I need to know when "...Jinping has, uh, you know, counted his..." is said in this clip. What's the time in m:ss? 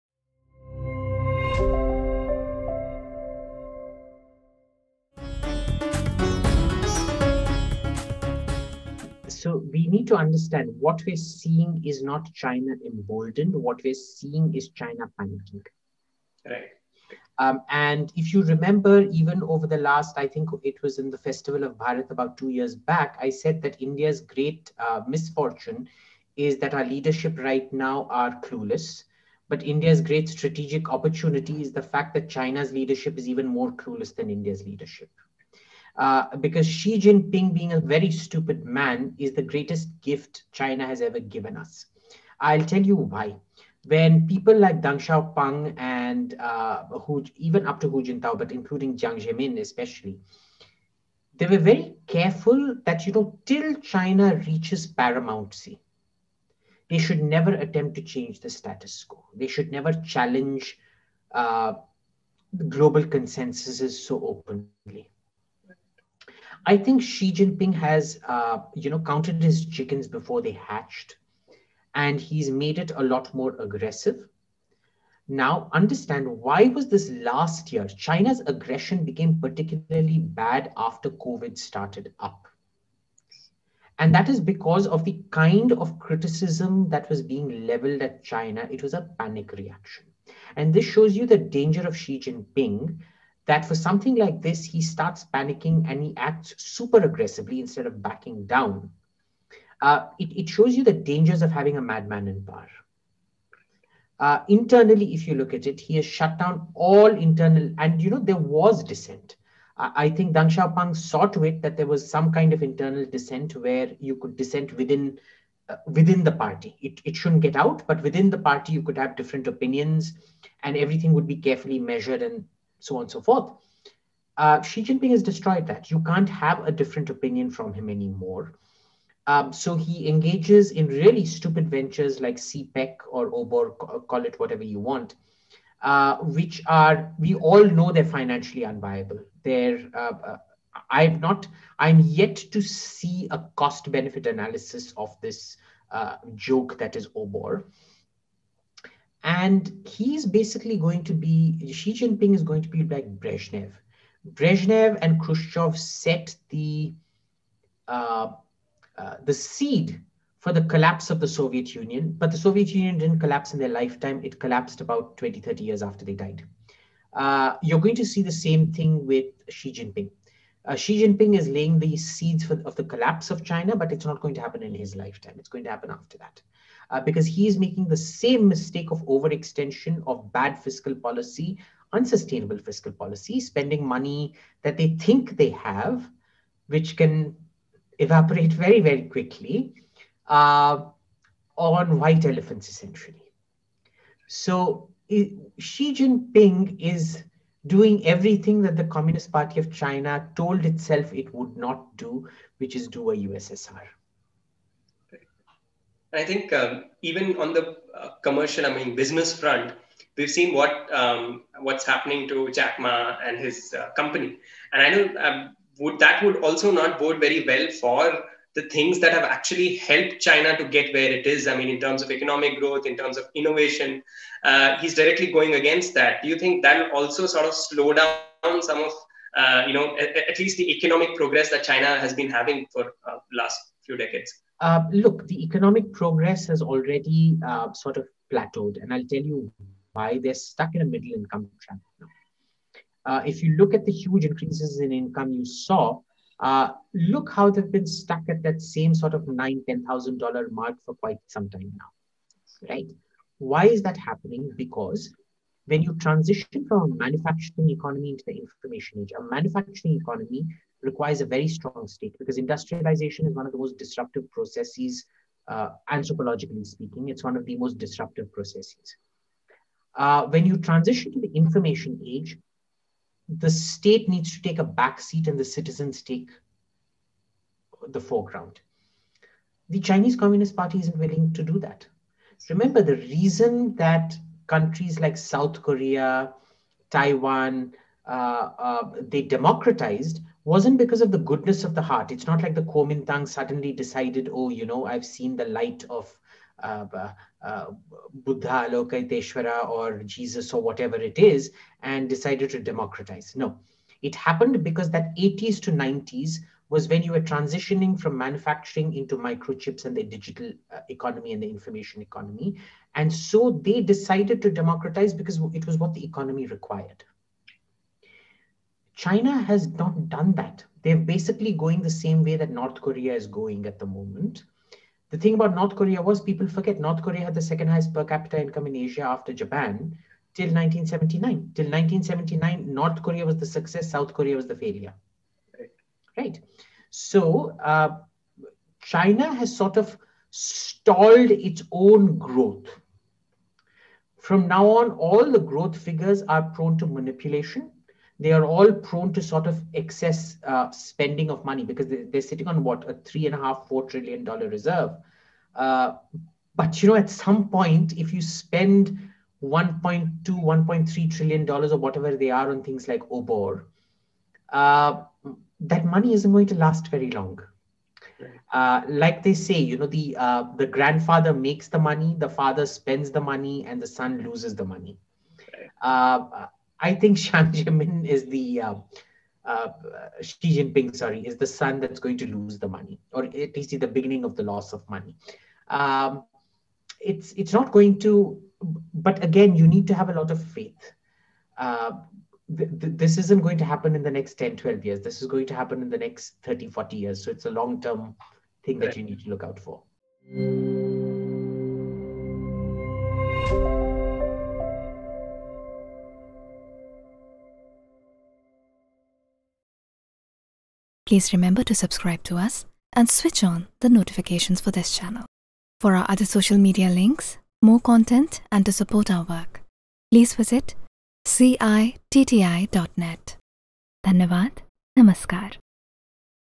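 1:07.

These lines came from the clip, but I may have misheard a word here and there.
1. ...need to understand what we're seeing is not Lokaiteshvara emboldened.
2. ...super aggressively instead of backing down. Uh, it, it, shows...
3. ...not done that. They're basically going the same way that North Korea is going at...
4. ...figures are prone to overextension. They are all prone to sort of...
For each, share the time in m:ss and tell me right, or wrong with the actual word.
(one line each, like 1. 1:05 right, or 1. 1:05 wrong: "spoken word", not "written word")
1. 0:09 wrong: "China", not "Lokaiteshvara"
2. 1:36 right
3. 5:19 right
4. 5:45 wrong: "manipulation", not "overextension".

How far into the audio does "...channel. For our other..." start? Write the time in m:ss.
6:54.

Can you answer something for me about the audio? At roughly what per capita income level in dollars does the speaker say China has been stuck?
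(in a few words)
9,000 to 10,000 dollars.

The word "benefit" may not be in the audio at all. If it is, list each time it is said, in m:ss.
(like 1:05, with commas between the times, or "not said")
2:23.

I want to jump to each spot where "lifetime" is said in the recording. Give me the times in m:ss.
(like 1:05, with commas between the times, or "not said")
2:43, 2:54.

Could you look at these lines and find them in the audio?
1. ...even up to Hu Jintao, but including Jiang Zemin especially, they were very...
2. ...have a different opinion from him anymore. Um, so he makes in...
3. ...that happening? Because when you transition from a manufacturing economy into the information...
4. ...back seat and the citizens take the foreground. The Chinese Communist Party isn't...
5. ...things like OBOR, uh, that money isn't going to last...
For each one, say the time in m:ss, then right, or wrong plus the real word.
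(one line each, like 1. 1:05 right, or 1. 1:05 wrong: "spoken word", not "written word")
1. 0:47 right
2. 2:06 wrong: "engages", not "makes"
3. 4:13 right
4. 4:34 right
5. 6:02 right.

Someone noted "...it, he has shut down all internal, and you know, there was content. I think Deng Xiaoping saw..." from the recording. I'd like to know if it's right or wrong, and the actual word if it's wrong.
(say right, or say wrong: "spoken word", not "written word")
wrong: "dissent", not "content".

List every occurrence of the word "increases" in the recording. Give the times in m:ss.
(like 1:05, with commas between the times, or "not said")
4:04.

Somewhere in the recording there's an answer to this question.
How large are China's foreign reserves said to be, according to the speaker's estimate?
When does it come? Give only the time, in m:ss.
5:52.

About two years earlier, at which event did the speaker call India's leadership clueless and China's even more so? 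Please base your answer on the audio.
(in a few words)
Festival of Bharat.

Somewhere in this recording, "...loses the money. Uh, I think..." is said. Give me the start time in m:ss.
6:14.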